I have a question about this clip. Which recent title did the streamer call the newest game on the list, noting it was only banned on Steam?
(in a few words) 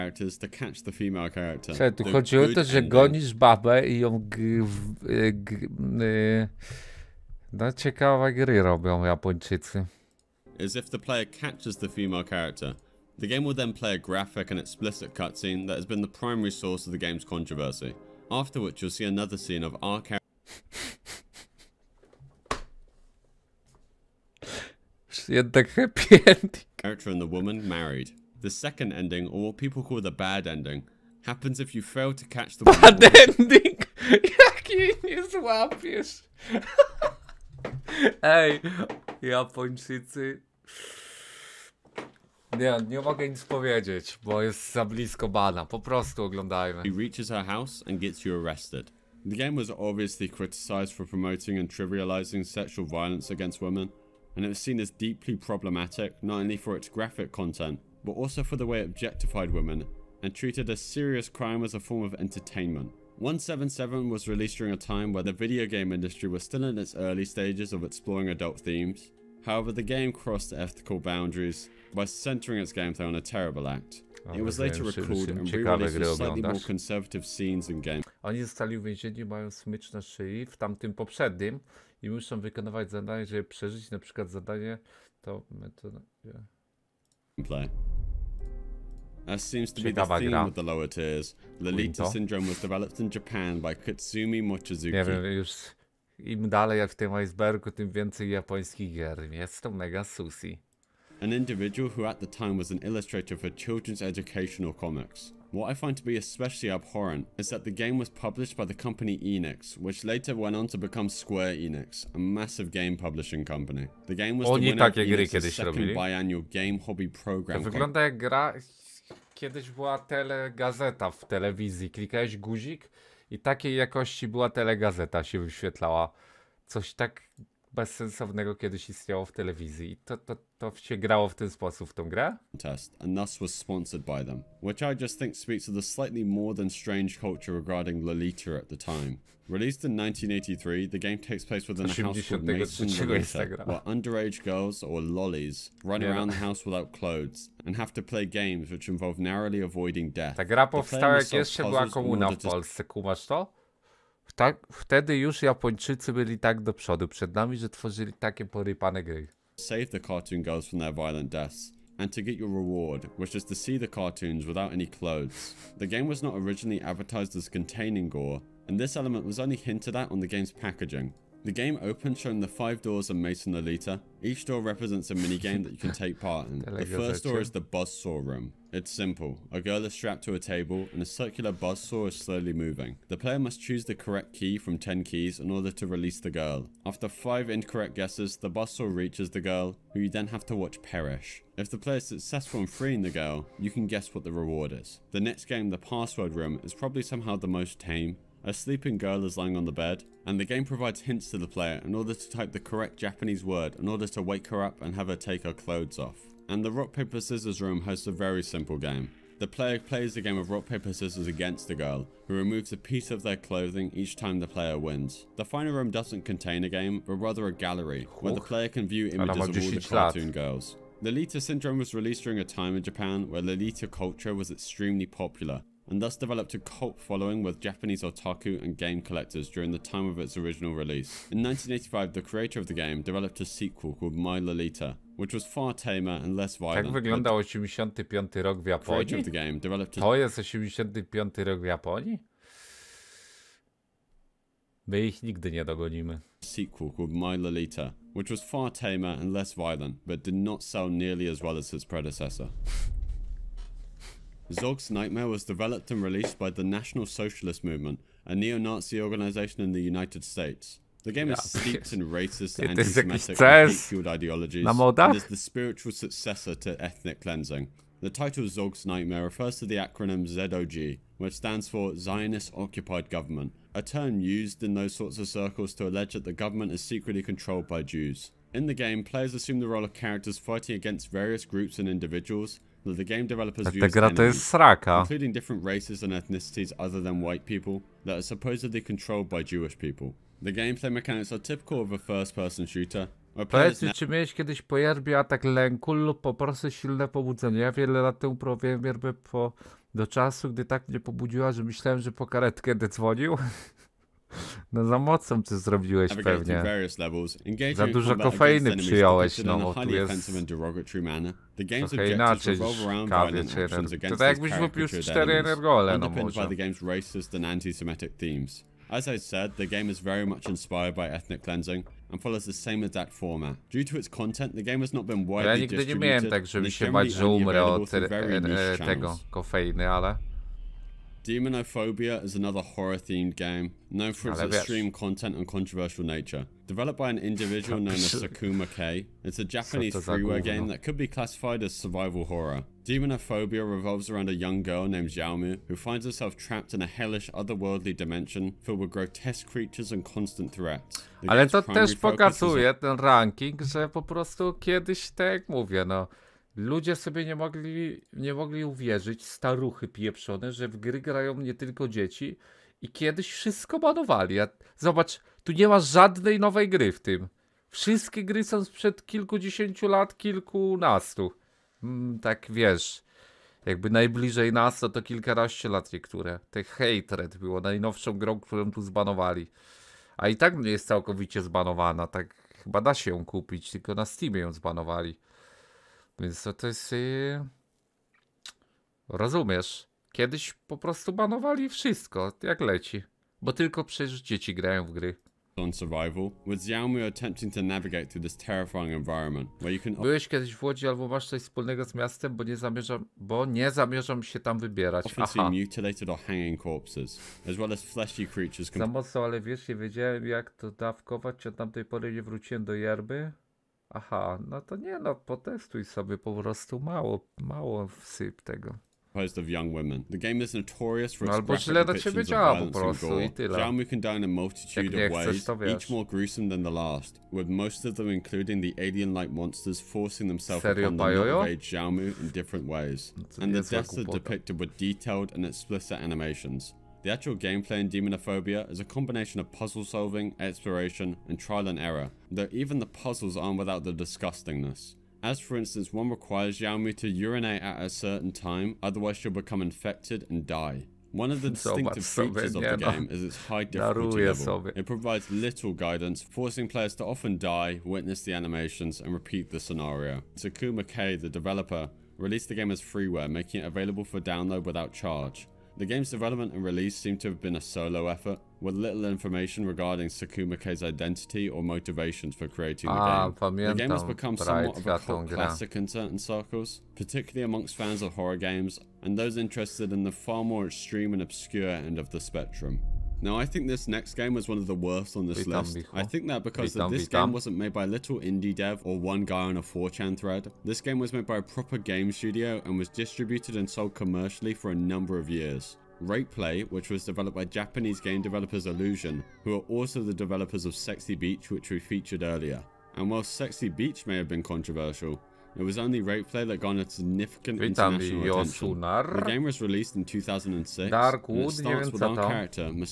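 Hatred.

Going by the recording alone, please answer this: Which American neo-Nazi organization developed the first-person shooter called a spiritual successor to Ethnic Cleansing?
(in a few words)
National Socialist Movement.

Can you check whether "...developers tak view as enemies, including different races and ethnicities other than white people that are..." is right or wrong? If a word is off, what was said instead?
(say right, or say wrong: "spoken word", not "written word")
right.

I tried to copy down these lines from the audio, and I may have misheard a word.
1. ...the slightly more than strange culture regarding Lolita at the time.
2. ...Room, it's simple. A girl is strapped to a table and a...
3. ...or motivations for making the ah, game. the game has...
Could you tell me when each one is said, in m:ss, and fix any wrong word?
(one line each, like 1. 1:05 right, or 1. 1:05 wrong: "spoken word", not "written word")
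1. 2:15 right
2. 2:58 right
3. 7:51 wrong: "creating", not "making".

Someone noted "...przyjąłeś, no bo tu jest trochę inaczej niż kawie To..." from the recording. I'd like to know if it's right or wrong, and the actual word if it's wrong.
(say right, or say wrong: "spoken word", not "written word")
right.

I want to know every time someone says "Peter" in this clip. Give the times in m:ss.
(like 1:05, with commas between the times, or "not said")
not said.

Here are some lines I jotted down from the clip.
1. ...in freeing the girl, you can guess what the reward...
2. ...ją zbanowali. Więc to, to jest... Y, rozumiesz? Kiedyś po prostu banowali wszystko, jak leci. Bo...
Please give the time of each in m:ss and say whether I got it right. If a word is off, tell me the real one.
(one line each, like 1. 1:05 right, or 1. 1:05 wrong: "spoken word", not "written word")
1. 3:12 right
2. 6:24 right.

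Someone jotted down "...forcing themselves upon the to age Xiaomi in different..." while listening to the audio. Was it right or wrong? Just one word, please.
right.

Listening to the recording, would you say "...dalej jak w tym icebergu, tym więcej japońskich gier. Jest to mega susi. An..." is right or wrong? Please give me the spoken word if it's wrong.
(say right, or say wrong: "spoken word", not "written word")
right.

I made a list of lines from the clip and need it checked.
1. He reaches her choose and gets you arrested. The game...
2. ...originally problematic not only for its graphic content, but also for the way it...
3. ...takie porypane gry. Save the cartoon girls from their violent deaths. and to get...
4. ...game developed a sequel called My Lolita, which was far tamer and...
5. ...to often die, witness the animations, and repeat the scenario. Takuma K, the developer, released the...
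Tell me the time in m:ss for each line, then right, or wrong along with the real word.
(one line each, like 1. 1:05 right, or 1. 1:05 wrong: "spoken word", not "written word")
1. 0:46 wrong: "house", not "choose"
2. 0:54 wrong: "deeply", not "originally"
3. 2:38 right
4. 3:52 right
5. 7:36 right.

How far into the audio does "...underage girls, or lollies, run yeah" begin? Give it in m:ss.
2:23.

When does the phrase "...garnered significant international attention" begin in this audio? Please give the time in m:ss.
8:26.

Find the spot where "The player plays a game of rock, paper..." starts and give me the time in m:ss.
3:29.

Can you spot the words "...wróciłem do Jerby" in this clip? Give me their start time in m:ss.
6:52.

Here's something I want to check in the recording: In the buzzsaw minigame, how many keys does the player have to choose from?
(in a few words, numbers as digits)
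10.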